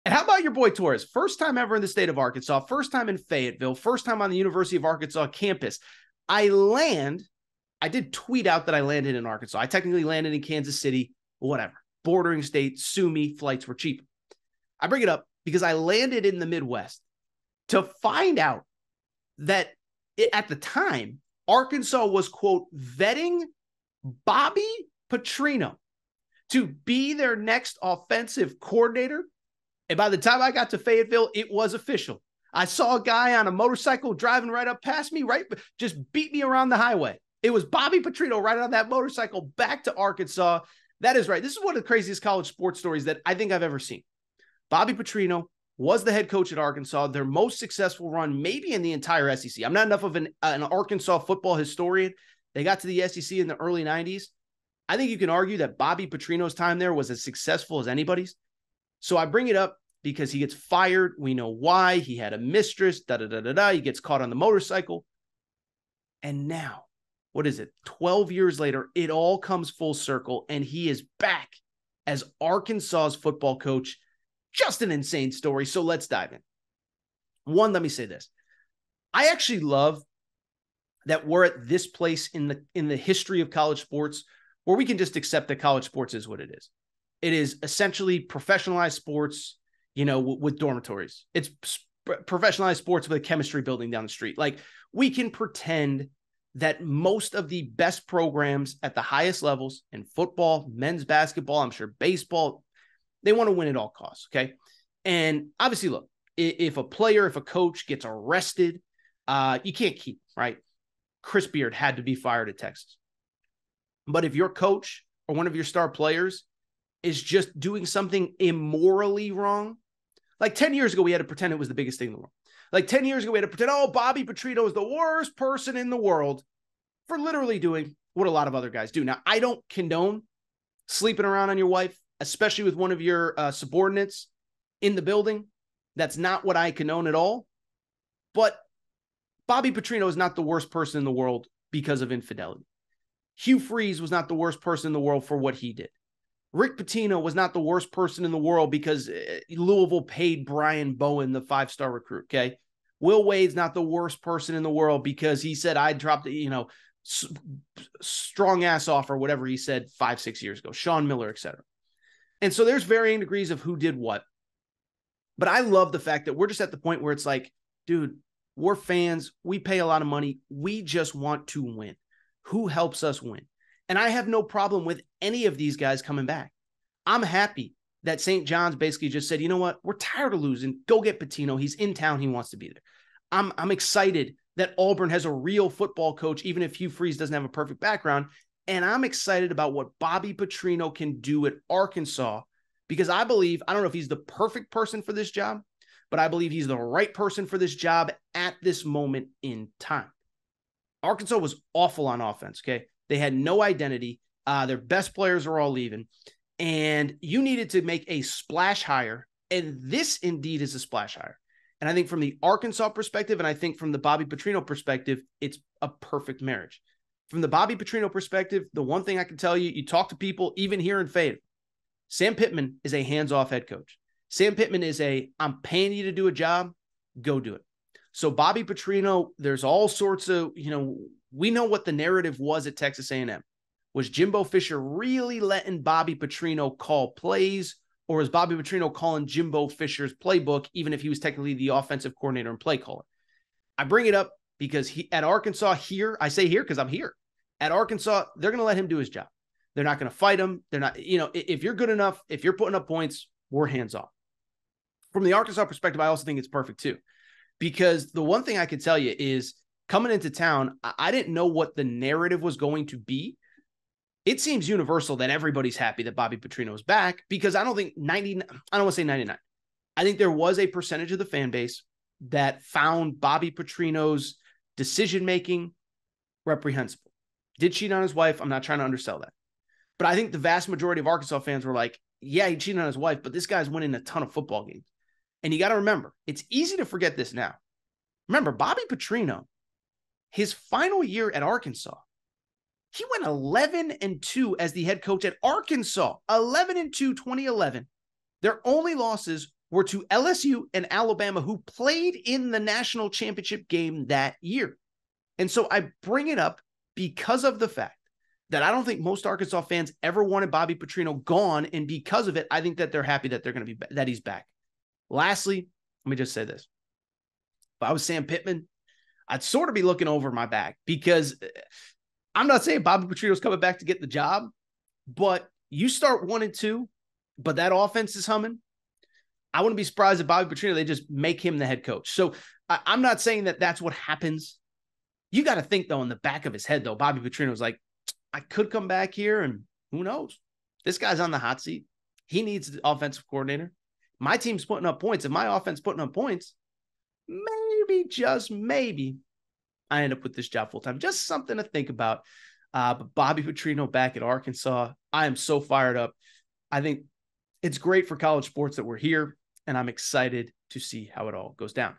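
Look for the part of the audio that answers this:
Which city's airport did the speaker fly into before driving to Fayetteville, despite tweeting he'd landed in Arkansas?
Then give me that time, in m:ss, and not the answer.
0:10.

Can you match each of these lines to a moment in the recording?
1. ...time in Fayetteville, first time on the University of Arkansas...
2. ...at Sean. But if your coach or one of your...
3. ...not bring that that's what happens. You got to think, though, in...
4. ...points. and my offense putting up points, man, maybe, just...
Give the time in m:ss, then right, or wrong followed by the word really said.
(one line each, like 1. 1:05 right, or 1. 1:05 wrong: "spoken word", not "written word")
1. 0:02 right
2. 1:52 wrong: "Texas", not "Sean"
3. 5:33 wrong: "saying", not "bring"
4. 5:44 right.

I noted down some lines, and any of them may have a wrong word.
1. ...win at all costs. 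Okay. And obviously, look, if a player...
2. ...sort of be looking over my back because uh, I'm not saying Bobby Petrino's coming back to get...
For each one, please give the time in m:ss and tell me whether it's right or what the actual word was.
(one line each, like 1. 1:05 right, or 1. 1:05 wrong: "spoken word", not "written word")
1. 1:43 right
2. 5:19 right.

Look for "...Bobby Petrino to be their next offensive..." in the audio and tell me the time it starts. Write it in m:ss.
0:24.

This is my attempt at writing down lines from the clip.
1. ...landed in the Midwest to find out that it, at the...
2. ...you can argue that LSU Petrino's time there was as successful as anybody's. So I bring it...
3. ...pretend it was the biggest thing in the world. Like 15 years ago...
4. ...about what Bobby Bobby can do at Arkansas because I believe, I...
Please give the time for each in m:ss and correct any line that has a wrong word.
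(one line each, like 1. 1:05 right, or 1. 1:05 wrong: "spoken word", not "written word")
1. 0:15 right
2. 0:55 wrong: "Bobby", not "LSU"
3. 2:01 wrong: "10", not "15"
4. 3:09 wrong: "Petrino", not "Bobby".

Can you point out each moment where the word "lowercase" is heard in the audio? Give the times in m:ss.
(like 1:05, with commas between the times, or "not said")
not said.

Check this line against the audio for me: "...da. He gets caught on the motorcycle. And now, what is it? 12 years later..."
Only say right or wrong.
right.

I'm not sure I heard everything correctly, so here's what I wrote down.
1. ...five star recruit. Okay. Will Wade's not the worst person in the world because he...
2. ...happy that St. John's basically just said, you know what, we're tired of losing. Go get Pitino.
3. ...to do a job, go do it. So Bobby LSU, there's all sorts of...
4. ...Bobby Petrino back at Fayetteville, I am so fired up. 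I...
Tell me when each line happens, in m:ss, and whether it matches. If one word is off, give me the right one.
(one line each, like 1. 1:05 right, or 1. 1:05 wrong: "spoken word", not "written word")
1. 2:31 right
2. 2:57 right
3. 3:46 wrong: "Petrino", not "LSU"
4. 5:53 wrong: "Arkansas", not "Fayetteville".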